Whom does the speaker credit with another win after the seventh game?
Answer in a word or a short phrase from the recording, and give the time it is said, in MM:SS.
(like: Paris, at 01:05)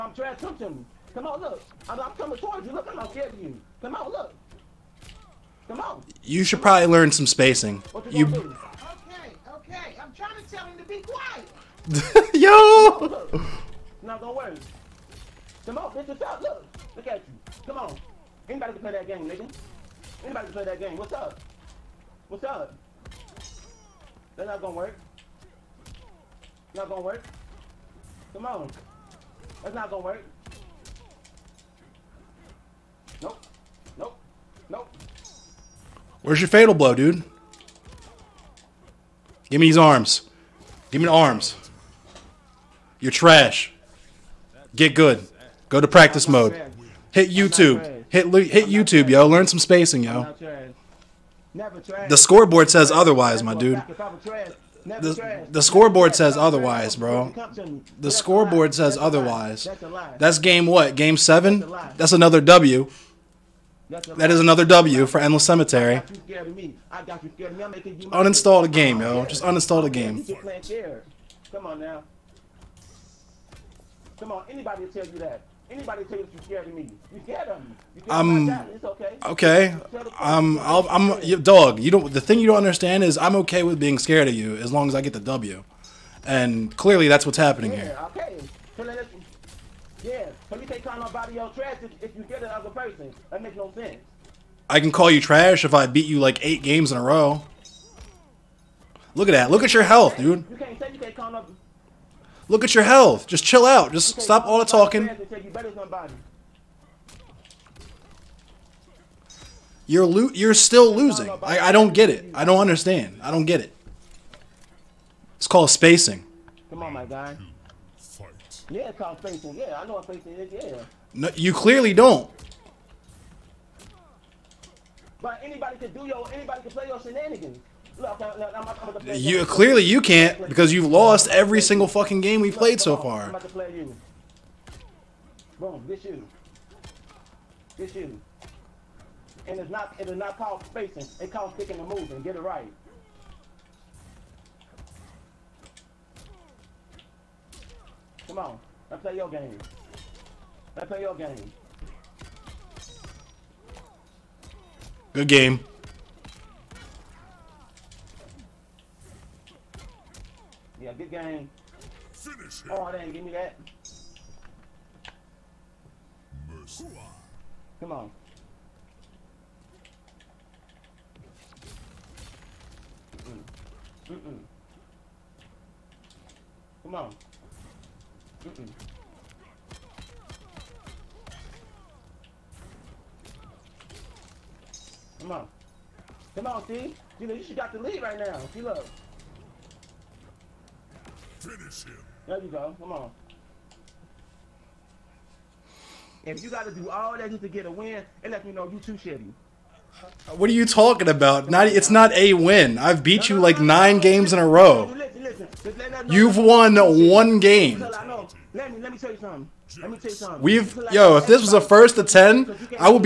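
Endless Cemetery, at 01:05.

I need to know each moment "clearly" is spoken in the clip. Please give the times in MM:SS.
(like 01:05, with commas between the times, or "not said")
01:26, 02:01, 02:09.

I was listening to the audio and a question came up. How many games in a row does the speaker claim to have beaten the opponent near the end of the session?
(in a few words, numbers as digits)
9.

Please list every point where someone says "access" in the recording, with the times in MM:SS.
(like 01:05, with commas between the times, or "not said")
not said.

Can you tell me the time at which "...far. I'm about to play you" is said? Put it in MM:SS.
02:12.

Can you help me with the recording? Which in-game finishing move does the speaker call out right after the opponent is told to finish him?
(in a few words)
Mercy.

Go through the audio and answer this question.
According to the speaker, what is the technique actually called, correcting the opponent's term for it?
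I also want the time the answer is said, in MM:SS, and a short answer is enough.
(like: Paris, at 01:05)
picking and moving, at 02:21.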